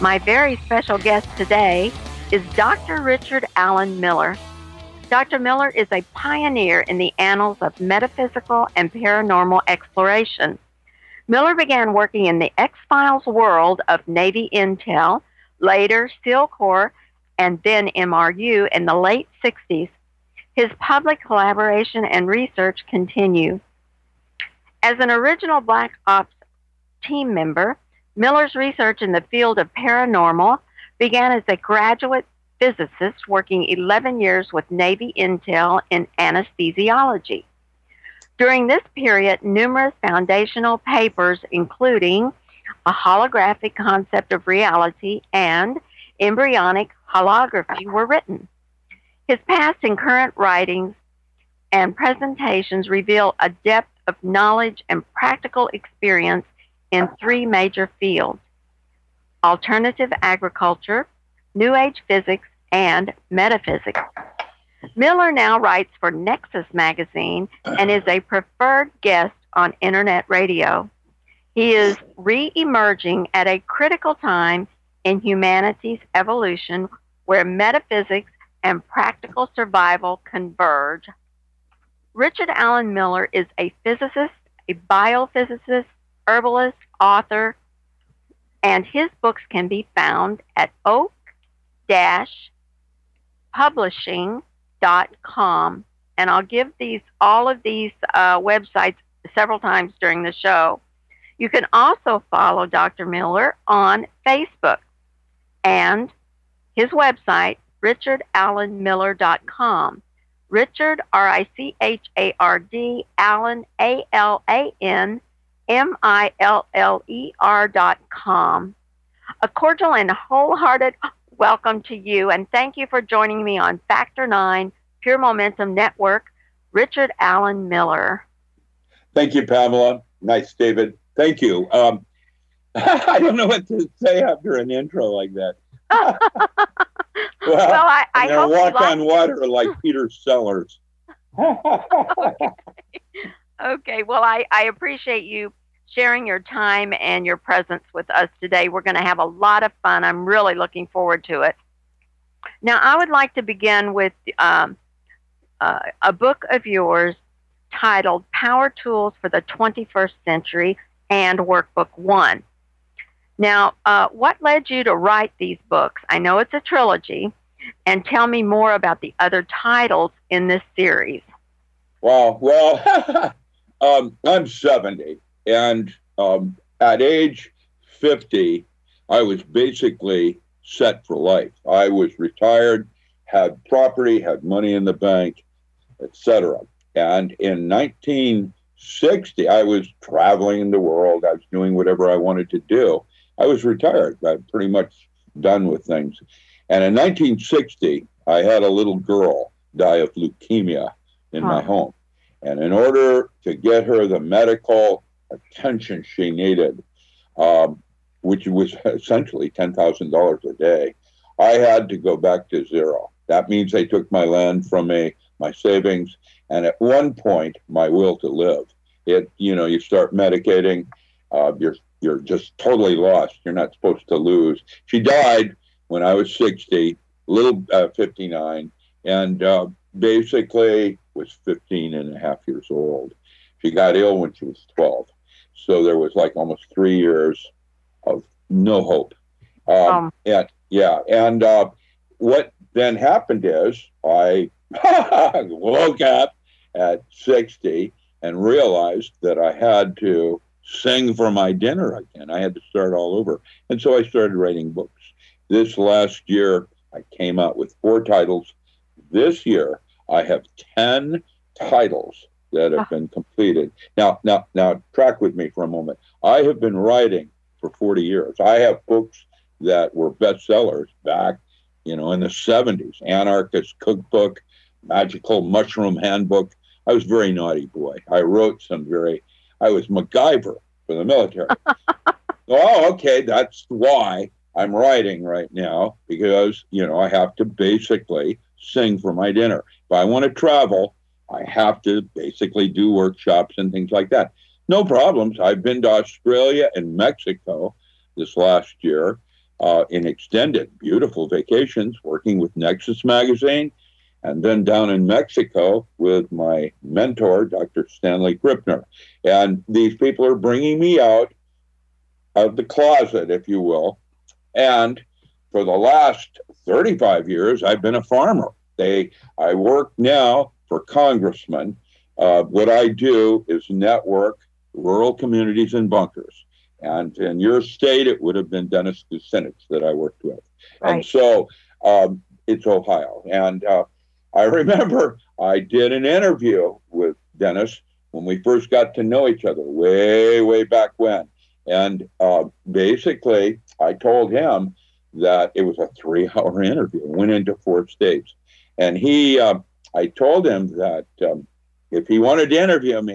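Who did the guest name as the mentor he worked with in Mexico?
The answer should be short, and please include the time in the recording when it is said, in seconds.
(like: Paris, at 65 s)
Dr. Stanley Krippner, at 307 s.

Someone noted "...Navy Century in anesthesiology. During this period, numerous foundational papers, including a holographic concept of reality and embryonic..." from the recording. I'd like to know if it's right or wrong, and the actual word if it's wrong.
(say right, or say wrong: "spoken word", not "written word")
wrong: "Intel", not "Century".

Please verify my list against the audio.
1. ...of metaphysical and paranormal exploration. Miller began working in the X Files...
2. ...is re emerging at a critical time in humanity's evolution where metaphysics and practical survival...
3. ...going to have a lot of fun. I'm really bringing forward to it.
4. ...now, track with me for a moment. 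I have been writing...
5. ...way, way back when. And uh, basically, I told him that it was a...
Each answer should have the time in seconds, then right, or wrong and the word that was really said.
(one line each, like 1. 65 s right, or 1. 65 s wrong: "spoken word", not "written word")
1. 7 s right
2. 71 s right
3. 148 s wrong: "looking", not "bringing"
4. 264 s right
5. 339 s right.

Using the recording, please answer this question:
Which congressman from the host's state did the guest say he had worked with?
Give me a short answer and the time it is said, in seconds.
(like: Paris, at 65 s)
Dennis Kucinich, at 328 s.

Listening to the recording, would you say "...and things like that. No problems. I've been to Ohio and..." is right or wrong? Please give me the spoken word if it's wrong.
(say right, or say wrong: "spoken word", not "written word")
wrong: "Australia", not "Ohio".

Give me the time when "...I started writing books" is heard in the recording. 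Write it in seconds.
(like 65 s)
253 s.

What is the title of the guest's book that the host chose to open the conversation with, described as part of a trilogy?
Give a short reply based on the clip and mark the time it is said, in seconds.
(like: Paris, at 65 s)
Power Tools for the 21st Century, at 158 s.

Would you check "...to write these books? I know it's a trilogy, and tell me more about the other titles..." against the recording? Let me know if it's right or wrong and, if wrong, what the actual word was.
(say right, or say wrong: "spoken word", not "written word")
right.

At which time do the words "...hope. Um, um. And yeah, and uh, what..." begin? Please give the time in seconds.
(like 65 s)
238 s.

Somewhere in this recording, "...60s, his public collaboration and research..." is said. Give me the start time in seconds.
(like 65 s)
19 s.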